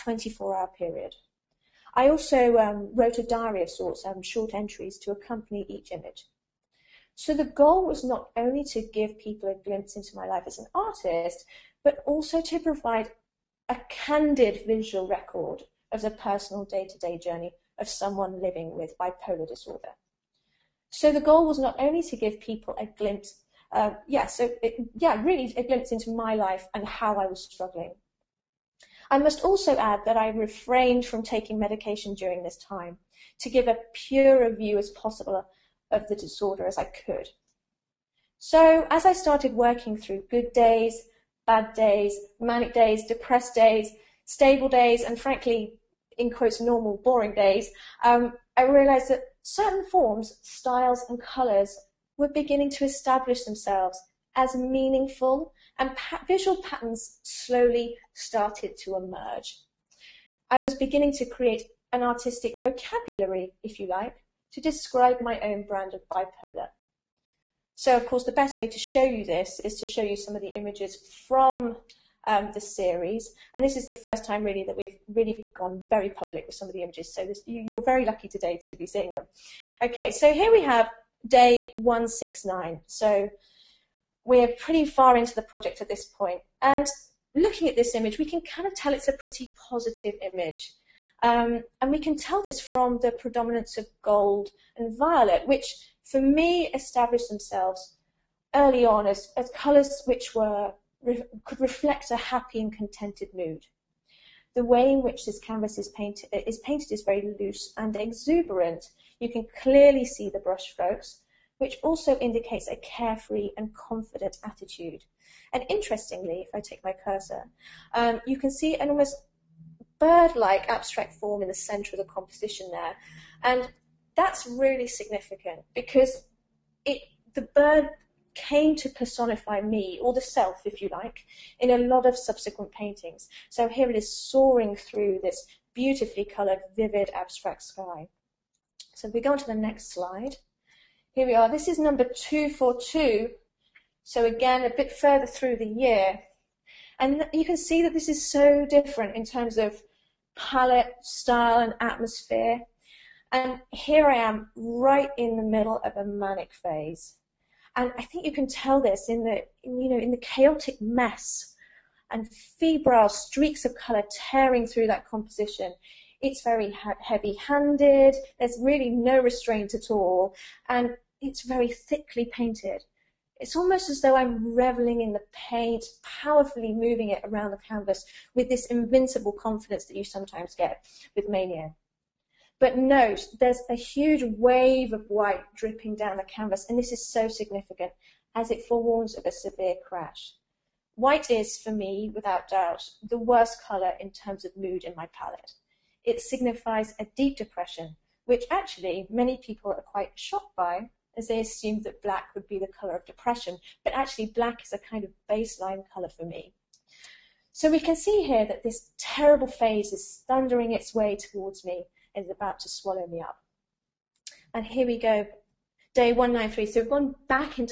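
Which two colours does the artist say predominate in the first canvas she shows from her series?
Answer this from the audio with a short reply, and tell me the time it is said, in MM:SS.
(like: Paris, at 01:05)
gold and violet, at 01:34.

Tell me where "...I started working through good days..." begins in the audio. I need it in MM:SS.
00:39.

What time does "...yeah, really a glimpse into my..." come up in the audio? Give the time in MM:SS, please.
00:24.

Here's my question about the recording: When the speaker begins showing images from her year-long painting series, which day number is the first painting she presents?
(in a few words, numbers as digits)
169.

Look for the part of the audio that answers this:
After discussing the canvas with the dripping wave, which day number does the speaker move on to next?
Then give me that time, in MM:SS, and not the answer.
03:36.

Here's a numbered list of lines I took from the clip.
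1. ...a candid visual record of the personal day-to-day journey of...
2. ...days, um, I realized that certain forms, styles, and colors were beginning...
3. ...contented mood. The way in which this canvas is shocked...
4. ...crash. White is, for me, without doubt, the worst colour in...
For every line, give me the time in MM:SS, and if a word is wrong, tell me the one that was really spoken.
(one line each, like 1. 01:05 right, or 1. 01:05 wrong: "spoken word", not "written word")
1. 00:13 right
2. 00:47 right
3. 01:42 wrong: "painted", not "shocked"
4. 03:09 right.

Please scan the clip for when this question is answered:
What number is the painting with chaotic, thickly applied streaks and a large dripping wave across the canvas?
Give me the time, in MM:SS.
02:22.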